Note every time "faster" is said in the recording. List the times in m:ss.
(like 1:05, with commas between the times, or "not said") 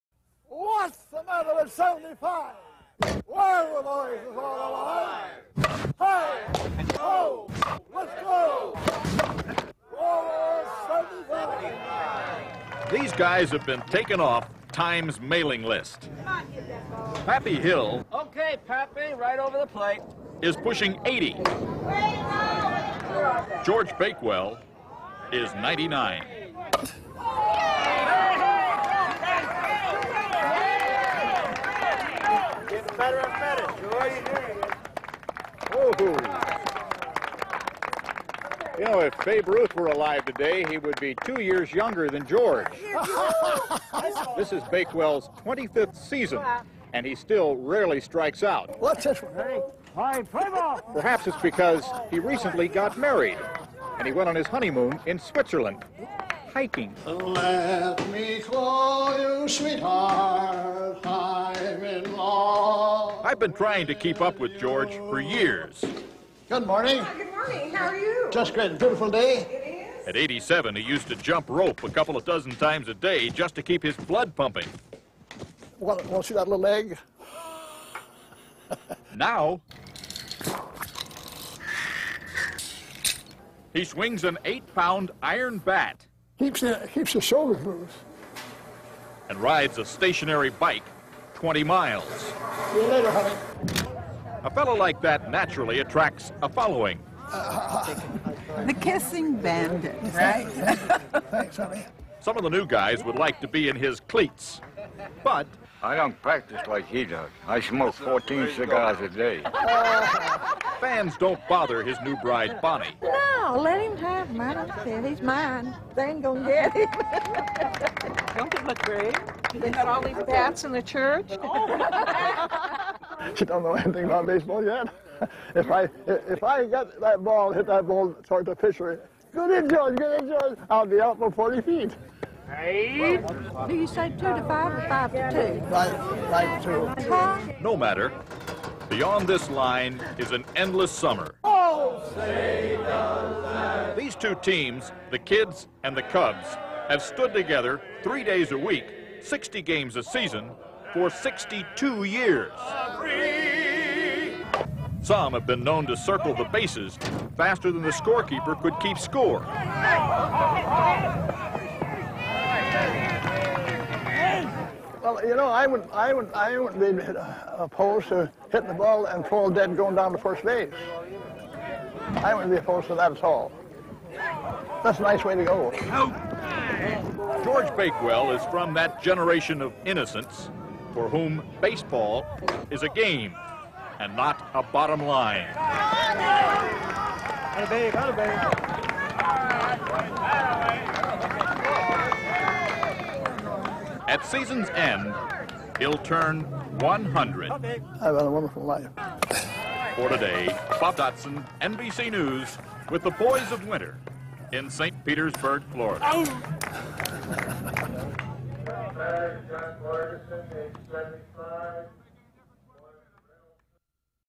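2:37.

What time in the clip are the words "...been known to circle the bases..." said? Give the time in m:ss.
2:35.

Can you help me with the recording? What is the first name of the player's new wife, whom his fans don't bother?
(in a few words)
Bonnie.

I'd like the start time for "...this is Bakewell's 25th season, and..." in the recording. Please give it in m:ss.
0:44.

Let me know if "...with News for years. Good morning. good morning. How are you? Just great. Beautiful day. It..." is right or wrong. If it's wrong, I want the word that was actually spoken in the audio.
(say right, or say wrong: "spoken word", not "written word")
wrong: "George", not "News".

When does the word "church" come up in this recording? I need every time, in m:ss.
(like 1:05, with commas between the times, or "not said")
2:00.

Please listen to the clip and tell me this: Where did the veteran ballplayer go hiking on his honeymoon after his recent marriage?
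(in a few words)
Switzerland.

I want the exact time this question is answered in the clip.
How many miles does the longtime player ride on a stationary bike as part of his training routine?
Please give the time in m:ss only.
1:31.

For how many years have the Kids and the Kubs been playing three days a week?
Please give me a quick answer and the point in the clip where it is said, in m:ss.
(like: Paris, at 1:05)
62, at 2:31.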